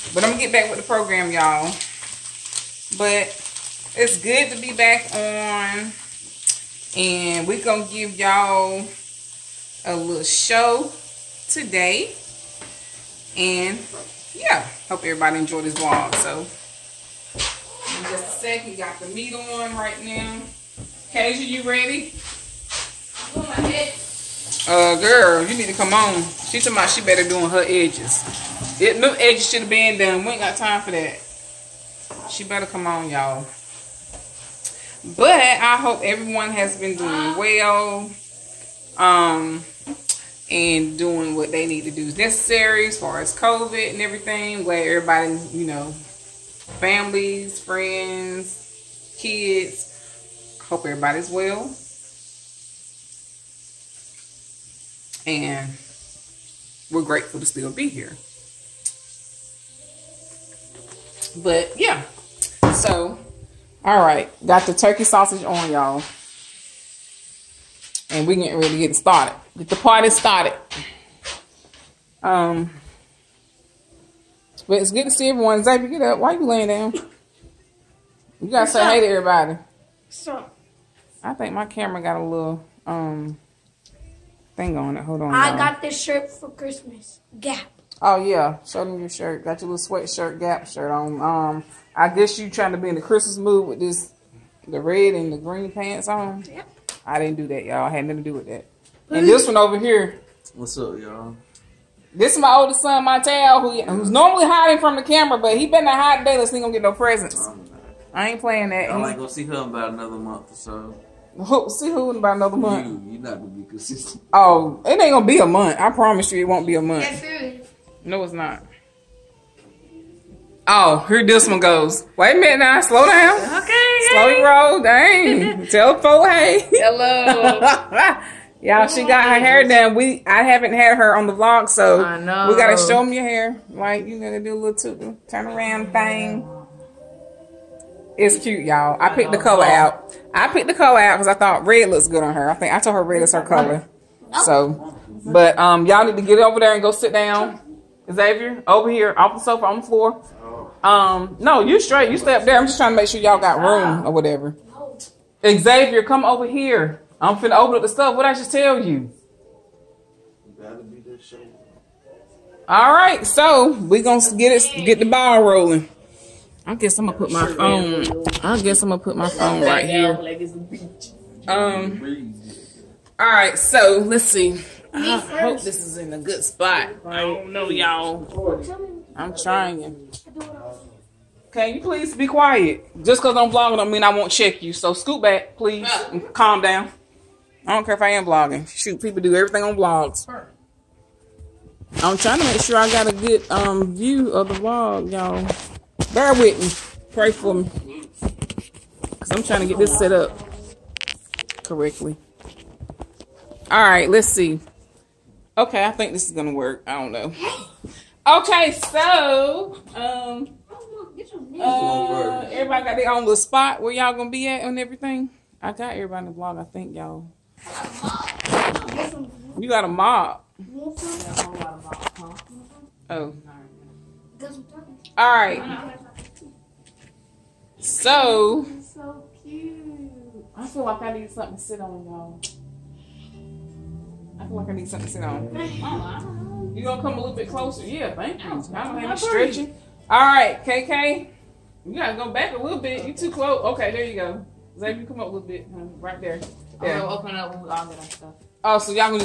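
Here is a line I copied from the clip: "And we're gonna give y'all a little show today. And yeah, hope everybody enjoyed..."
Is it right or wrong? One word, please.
right.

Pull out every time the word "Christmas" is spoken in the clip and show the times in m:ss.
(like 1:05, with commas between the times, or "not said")
1:26, 1:33.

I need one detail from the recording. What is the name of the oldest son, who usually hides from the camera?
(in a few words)
Montel.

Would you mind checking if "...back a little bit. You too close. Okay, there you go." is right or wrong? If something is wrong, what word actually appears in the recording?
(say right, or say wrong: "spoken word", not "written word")
right.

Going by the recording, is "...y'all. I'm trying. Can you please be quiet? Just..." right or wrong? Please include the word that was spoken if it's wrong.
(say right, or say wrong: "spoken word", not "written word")
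right.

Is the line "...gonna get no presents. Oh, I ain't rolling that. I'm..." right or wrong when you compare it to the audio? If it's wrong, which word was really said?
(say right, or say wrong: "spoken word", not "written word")
wrong: "playing", not "rolling".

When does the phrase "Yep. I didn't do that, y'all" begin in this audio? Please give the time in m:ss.
1:36.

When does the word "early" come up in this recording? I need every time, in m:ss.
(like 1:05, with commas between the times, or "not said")
not said.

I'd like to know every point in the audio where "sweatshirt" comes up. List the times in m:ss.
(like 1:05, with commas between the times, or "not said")
1:29.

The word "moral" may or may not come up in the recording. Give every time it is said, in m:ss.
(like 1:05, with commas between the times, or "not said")
not said.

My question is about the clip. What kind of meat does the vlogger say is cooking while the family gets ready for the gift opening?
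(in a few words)
Turkey sausage.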